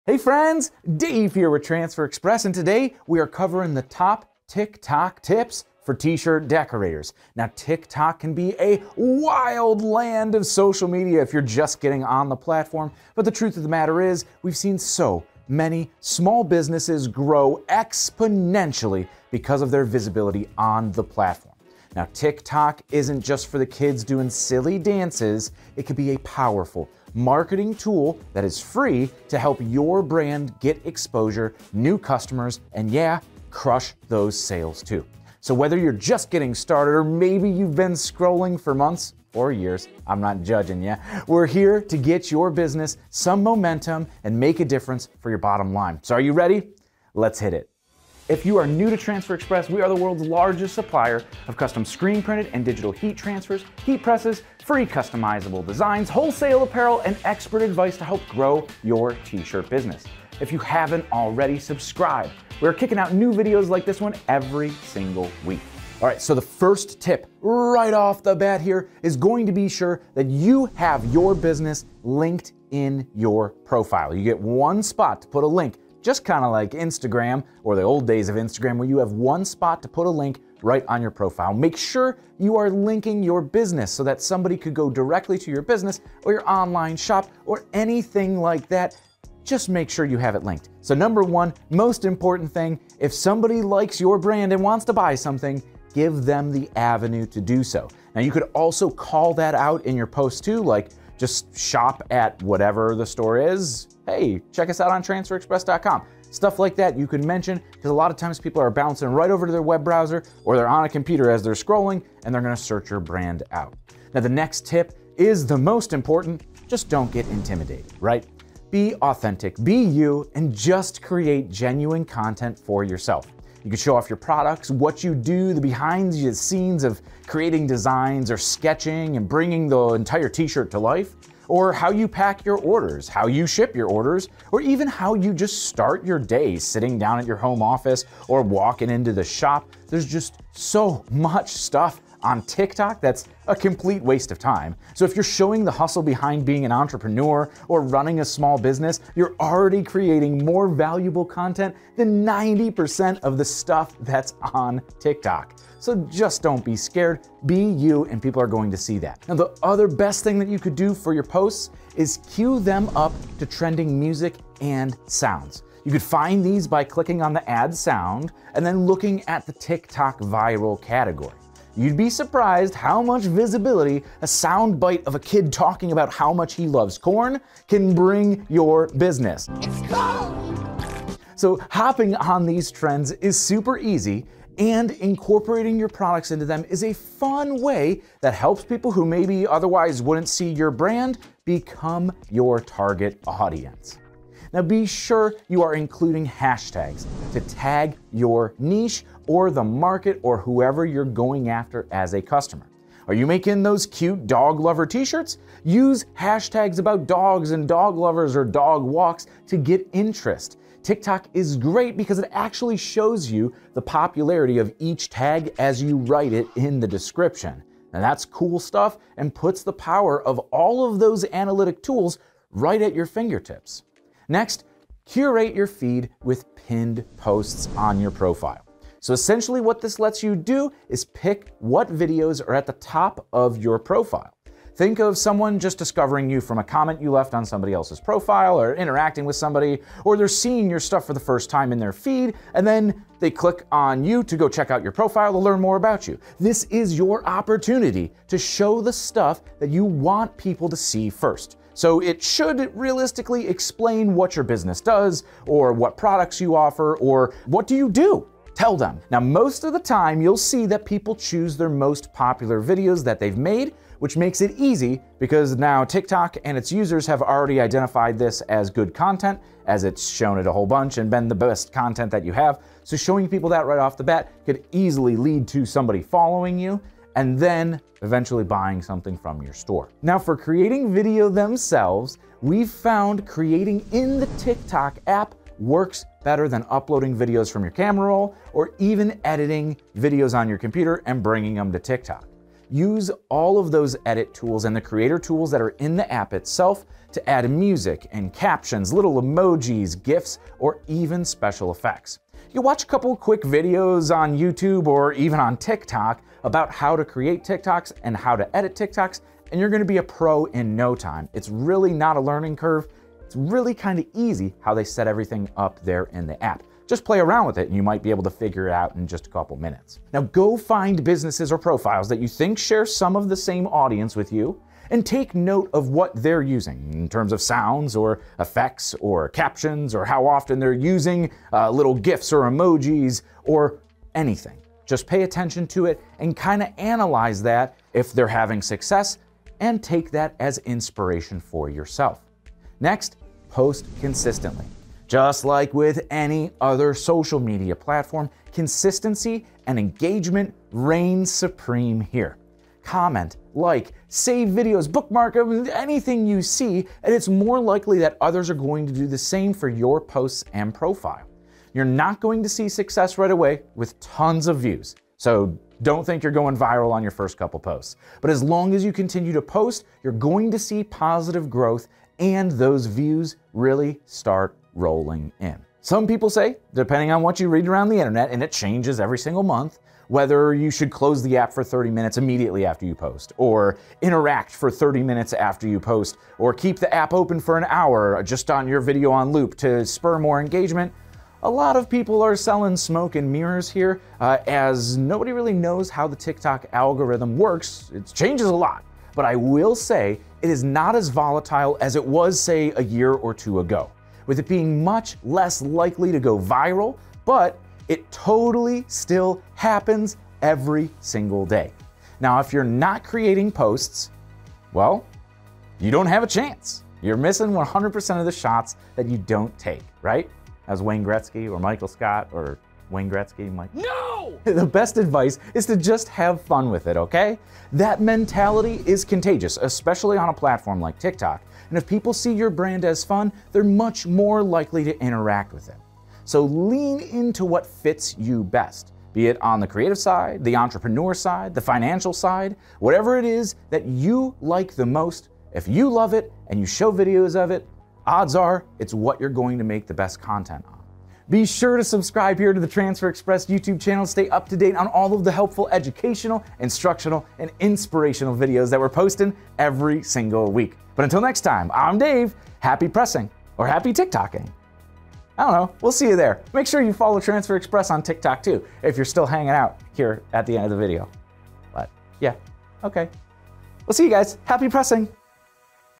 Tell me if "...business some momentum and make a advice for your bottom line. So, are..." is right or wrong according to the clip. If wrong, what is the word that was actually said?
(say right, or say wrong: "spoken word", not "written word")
wrong: "difference", not "advice".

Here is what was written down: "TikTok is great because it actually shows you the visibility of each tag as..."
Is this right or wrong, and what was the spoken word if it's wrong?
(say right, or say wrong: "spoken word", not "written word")
wrong: "popularity", not "visibility".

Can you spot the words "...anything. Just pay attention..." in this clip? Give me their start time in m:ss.
5:34.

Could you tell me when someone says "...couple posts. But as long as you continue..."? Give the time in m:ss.
6:07.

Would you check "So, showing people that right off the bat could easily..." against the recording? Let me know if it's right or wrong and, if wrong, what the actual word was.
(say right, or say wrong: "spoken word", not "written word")
right.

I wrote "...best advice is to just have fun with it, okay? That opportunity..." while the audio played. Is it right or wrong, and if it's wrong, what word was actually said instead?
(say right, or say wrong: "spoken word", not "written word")
wrong: "mentality", not "opportunity".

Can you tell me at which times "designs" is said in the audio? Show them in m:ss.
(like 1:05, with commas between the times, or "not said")
0:55, 2:07.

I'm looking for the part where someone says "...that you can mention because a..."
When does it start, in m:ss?
1:46.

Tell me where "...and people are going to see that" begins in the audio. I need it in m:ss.
2:38.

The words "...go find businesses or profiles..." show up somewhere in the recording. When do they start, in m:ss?
5:20.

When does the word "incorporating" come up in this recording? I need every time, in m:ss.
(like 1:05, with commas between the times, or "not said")
3:04.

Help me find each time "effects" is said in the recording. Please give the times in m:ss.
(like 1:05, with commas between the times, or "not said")
5:01, 5:28.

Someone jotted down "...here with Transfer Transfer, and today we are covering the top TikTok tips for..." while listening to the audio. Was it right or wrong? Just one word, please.
wrong.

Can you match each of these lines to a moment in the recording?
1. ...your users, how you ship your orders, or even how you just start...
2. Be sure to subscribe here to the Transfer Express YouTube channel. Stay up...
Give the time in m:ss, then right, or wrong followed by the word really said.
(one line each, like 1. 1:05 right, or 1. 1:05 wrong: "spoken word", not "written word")
1. 2:12 wrong: "orders", not "users"
2. 7:31 right.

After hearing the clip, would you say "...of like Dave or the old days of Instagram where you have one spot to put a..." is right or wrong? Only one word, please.
wrong.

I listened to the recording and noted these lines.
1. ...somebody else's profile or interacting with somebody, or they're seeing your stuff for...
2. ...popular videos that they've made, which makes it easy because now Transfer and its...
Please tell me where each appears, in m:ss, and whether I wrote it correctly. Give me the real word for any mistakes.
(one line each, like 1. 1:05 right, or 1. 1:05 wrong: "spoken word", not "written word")
1. 3:57 right
2. 4:22 wrong: "TikTok", not "Transfer".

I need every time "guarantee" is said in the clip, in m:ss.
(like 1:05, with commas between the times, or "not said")
not said.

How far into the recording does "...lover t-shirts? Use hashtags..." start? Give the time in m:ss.
3:24.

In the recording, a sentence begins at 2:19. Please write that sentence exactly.
There's just so much stuff on TikTok, that's a complete waste of time.